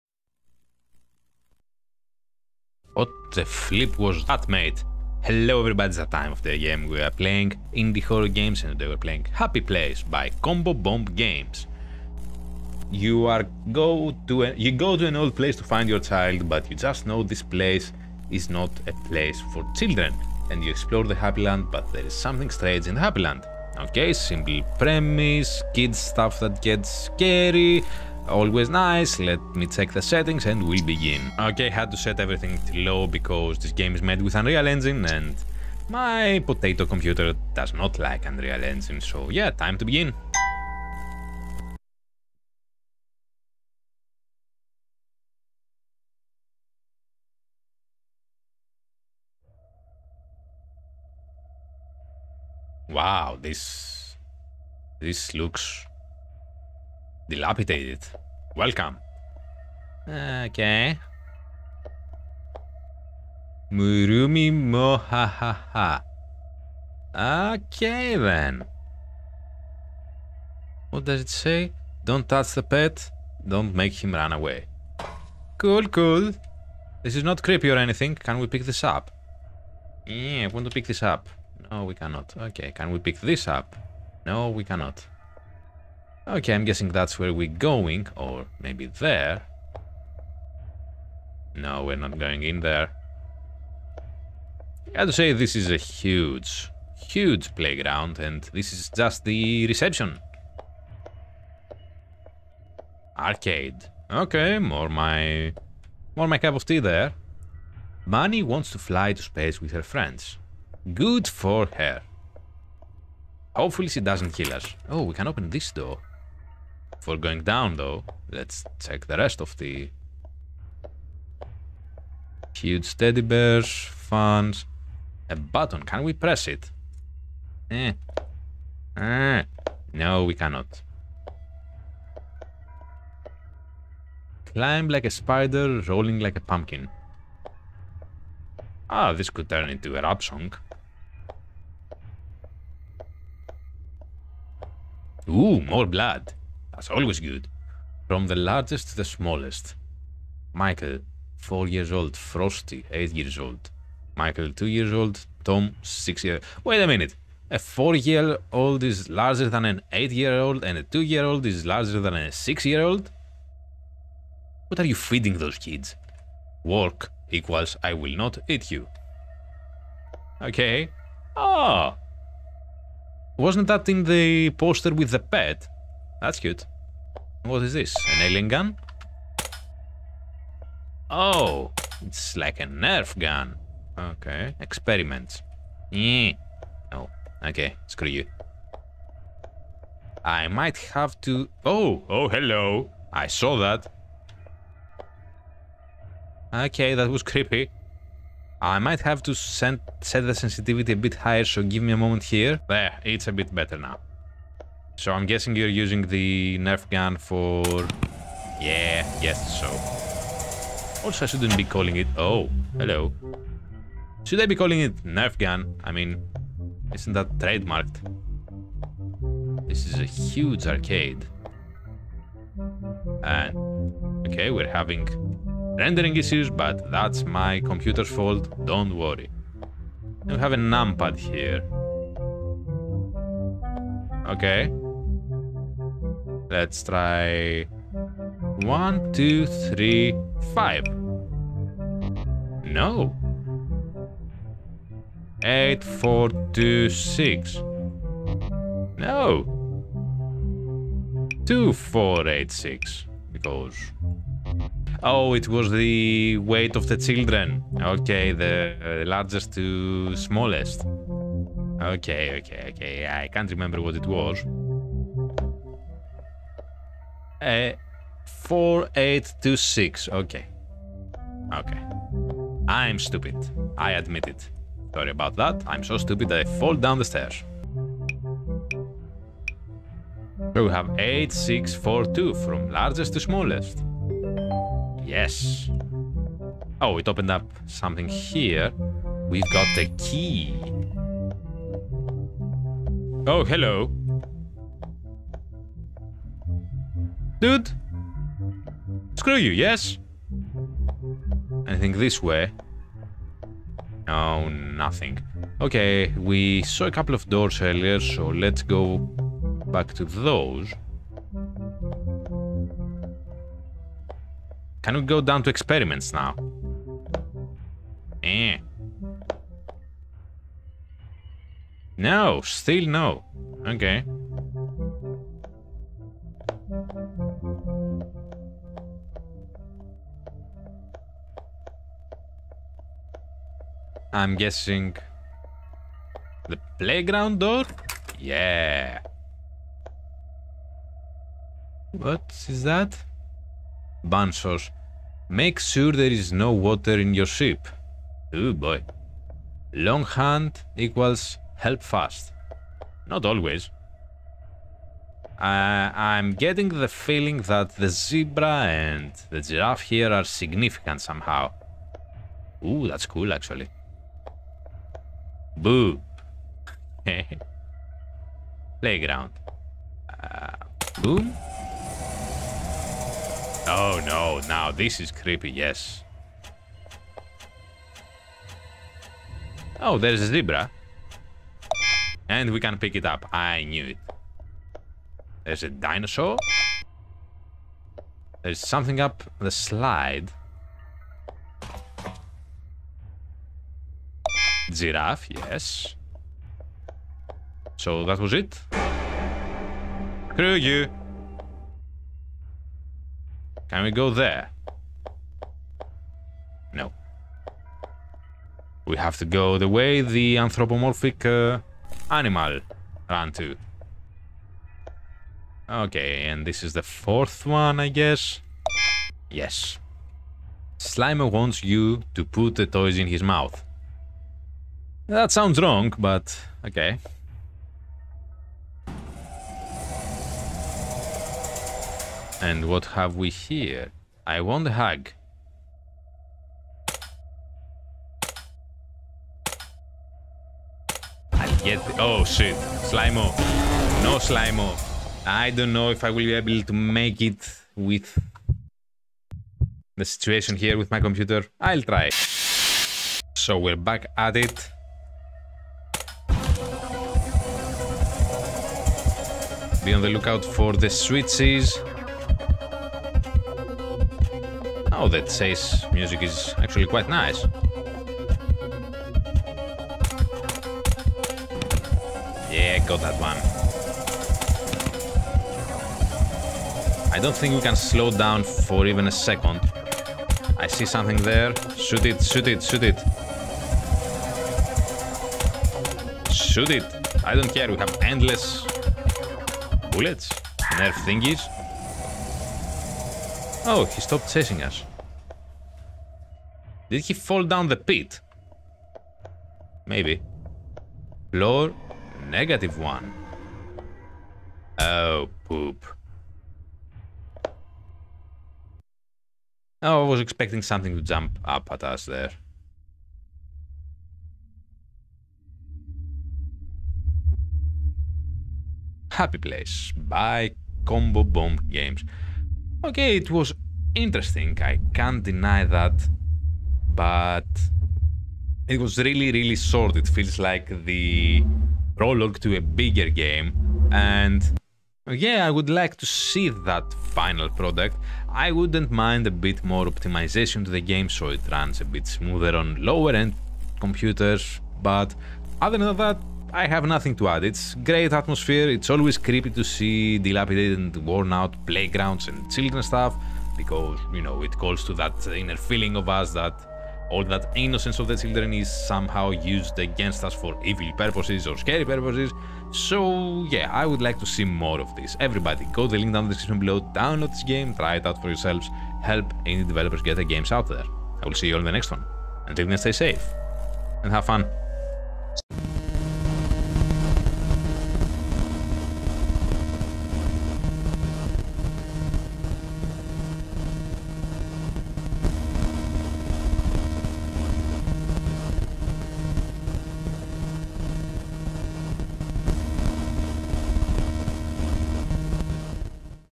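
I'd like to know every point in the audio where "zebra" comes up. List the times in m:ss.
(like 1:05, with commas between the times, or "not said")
5:57, 6:20.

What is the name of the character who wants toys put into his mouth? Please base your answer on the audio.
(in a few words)
Slimer.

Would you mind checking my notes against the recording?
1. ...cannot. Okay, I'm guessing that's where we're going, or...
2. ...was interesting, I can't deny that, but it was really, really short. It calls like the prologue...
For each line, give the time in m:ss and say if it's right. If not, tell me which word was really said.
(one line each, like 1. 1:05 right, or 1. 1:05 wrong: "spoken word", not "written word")
1. 1:24 right
2. 8:43 wrong: "feels", not "calls".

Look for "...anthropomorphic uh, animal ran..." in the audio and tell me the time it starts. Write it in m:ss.
6:50.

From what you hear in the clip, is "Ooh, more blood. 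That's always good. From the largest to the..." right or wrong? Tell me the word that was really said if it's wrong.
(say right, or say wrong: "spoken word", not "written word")
right.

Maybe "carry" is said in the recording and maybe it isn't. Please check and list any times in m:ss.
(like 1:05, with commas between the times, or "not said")
not said.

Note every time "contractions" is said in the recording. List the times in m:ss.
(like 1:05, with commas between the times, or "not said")
not said.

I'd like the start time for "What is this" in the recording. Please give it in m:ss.
2:57.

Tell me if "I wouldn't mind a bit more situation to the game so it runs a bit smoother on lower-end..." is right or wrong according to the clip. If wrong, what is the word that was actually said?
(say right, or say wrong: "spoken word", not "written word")
wrong: "optimization", not "situation".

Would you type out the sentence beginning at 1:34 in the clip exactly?
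I have to say, this is a huge, huge playground, and this is just the reception.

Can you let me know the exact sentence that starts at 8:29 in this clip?
Oh, I was expecting something to jump up at us there.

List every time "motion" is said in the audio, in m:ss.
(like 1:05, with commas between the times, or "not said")
not said.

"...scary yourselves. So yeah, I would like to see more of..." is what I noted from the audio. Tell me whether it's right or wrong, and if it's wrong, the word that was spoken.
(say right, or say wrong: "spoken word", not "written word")
wrong: "purposes", not "yourselves".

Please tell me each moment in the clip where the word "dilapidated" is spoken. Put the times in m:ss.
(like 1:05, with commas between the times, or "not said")
0:57, 9:10.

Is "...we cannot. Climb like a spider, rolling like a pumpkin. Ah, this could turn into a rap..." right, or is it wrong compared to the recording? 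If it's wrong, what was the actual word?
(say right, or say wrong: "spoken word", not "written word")
right.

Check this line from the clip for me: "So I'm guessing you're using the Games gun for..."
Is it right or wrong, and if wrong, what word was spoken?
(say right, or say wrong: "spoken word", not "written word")
wrong: "Nerf", not "Games".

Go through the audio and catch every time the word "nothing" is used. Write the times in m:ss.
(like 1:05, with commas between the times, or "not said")
5:04, 9:06.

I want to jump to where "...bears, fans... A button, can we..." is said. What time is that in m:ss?
2:03.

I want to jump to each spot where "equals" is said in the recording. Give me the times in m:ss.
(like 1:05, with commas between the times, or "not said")
2:47, 5:50.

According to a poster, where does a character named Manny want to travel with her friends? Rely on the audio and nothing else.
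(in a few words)
space.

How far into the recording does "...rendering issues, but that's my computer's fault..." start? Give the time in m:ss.
3:45.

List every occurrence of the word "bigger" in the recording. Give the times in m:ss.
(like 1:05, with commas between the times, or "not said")
8:52.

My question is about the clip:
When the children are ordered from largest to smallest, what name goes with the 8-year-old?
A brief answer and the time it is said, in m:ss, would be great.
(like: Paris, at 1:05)
Frosty, at 2:32.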